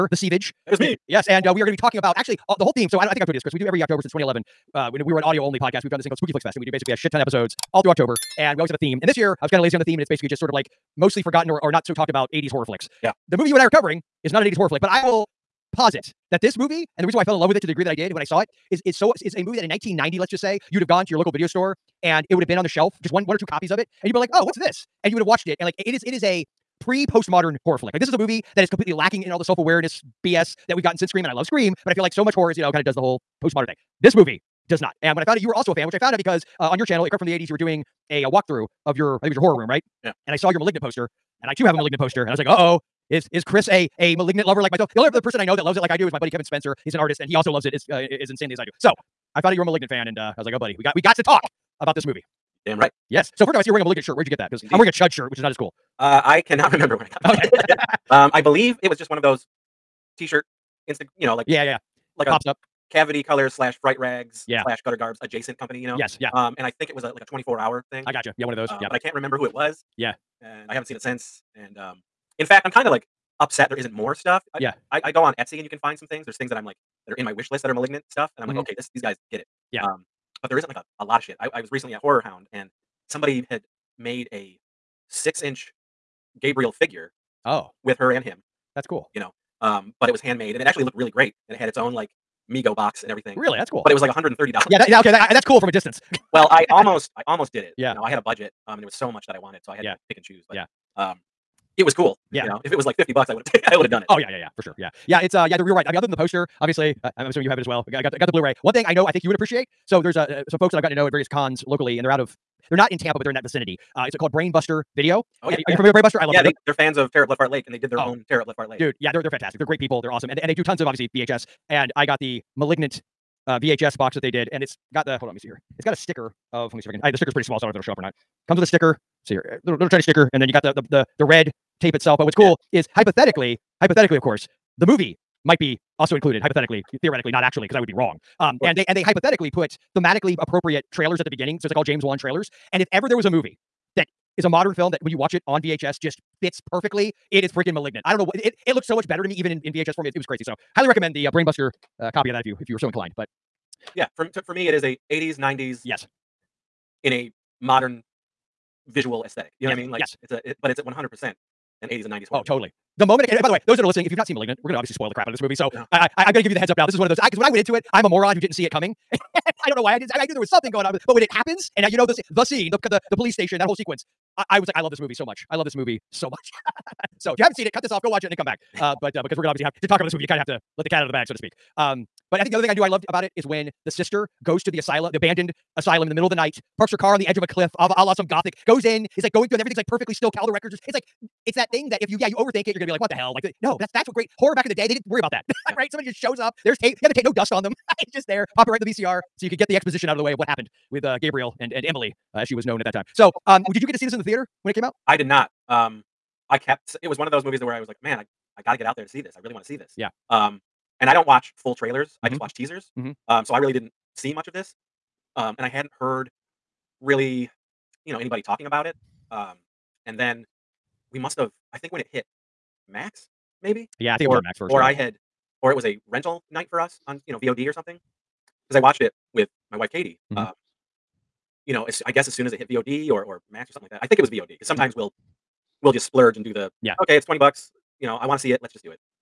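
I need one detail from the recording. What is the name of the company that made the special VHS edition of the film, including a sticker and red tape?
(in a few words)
Brainbuster Video.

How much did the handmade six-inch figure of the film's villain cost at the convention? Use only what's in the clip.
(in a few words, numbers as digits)
$130.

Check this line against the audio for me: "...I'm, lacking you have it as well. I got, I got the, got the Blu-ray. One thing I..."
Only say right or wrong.
wrong.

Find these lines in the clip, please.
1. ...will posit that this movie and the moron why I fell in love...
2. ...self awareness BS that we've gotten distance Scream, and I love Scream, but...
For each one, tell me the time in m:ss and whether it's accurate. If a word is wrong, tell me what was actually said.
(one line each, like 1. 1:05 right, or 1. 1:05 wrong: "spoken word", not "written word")
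1. 0:15 wrong: "reason", not "moron"
2. 0:29 wrong: "since", not "distance".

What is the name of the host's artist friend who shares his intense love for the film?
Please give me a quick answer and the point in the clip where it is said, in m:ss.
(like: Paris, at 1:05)
Kevin Spencer, at 0:46.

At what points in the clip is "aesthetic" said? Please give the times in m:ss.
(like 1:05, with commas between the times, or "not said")
2:39.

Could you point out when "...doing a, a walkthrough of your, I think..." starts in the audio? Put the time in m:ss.
0:37.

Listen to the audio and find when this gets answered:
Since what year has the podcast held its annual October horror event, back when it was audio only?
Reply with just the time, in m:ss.
0:04.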